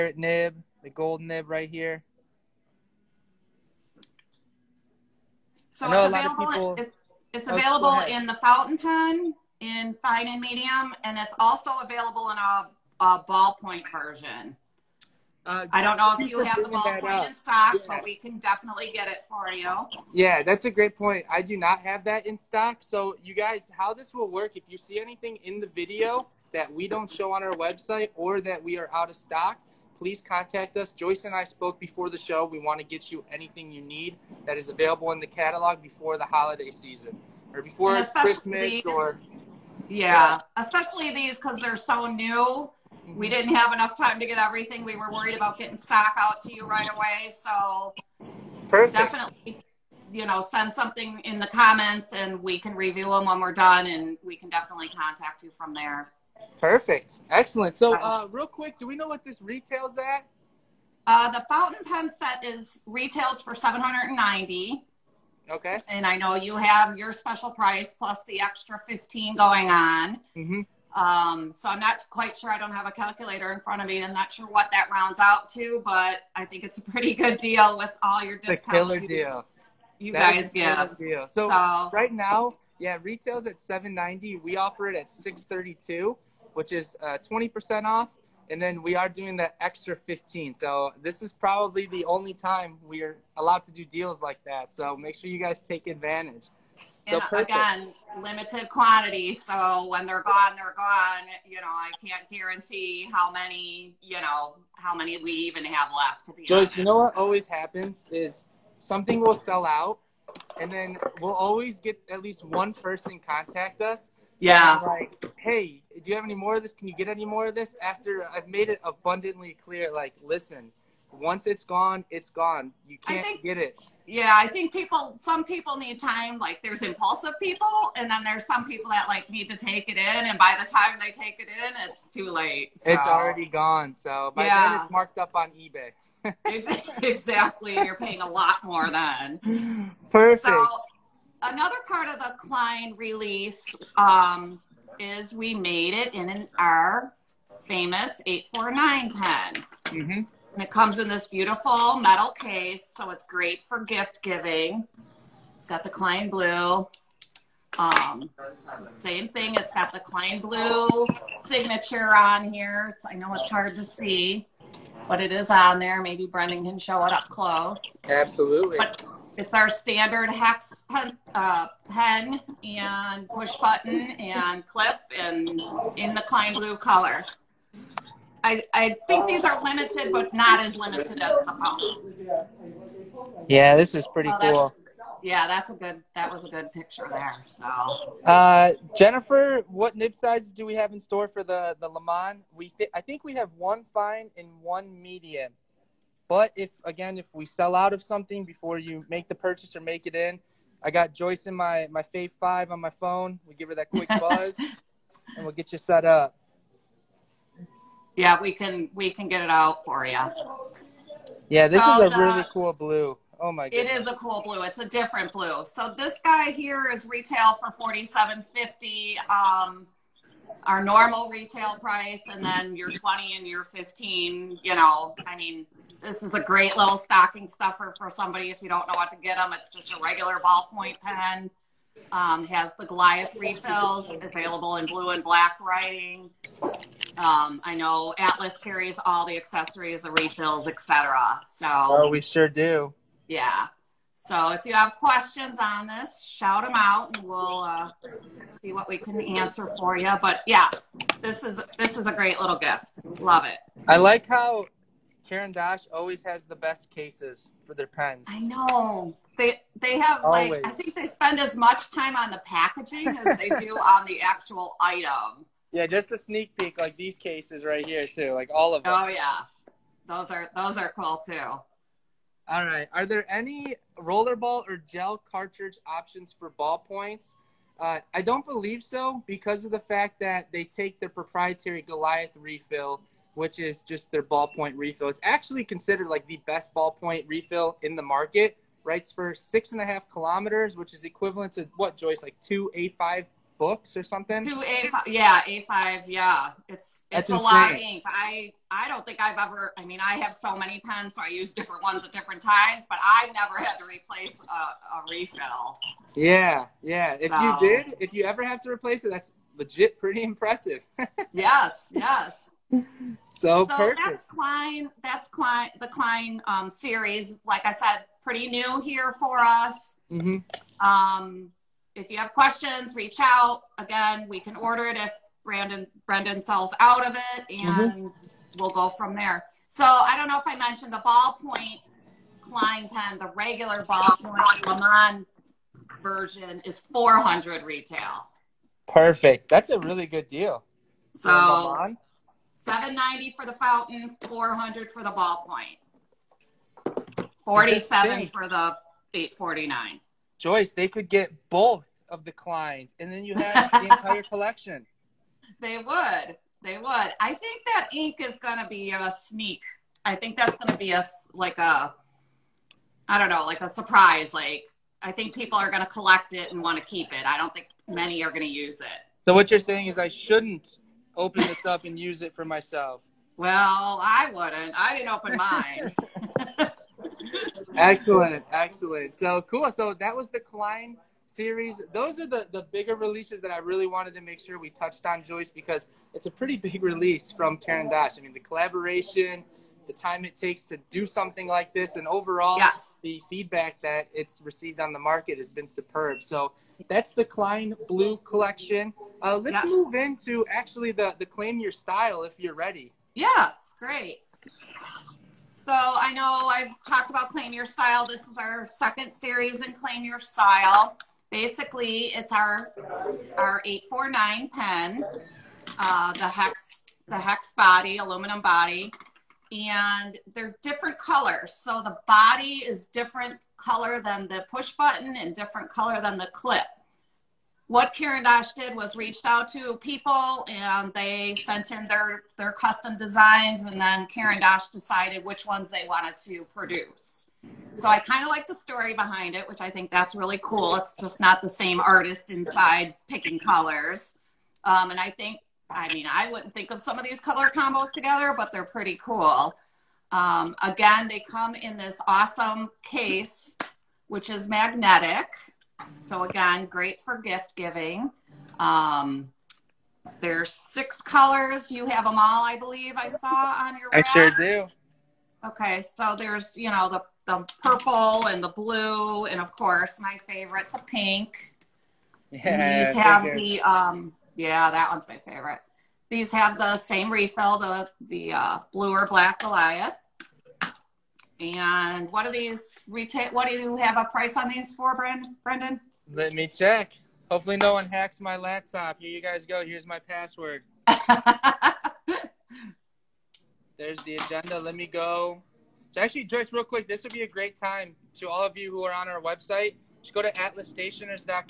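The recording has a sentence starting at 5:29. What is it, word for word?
So I don't know if I mentioned the ballpoint Klein pen, the regular ballpoint Léman version is 400 retail.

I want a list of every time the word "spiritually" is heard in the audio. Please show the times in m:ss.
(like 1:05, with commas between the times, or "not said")
not said.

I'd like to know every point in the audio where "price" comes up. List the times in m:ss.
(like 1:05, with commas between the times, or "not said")
1:07, 3:41, 8:04.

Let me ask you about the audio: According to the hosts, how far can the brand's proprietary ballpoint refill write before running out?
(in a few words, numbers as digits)
6.5 kilometers.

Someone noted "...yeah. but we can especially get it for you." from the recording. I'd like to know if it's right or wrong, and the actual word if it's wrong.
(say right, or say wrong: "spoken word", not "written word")
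wrong: "definitely", not "especially".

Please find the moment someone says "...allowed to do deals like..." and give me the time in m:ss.
1:33.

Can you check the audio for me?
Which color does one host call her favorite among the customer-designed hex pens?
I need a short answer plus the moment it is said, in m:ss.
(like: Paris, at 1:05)
Pink, at 7:50.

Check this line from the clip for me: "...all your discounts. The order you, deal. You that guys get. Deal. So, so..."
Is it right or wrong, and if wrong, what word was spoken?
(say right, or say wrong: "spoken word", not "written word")
wrong: "killer", not "order".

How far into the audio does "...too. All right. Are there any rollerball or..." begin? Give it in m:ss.
4:31.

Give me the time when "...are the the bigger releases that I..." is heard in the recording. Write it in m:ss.
6:22.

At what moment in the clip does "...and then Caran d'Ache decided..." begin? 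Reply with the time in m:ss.
7:13.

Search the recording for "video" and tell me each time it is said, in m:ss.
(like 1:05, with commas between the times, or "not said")
0:25.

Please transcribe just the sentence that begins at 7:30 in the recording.
Um, again, they come in this awesome case, which is magnetic.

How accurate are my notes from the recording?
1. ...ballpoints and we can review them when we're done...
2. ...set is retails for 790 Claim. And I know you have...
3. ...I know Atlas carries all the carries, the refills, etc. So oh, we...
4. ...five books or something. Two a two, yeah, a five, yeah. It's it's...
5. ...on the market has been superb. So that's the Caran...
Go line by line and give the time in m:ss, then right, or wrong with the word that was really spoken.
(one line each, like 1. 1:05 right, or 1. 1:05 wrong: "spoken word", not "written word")
1. 0:51 wrong: "comments", not "ballpoints"
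2. 1:02 wrong: "Okay", not "Claim"
3. 3:57 wrong: "accessories", not "carries"
4. 4:52 wrong: "five", not "two"
5. 6:34 wrong: "Klein", not "Caran".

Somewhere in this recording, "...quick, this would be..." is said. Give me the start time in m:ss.
8:16.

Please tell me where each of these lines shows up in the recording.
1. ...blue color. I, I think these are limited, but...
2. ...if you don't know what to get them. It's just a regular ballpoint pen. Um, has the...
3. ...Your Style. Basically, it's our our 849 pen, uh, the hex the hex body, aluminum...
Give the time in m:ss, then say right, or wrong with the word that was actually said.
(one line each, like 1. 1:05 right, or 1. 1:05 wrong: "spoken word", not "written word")
1. 2:56 right
2. 3:48 right
3. 6:50 right.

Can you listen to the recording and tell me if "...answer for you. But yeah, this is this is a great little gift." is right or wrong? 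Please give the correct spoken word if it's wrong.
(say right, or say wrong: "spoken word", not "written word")
right.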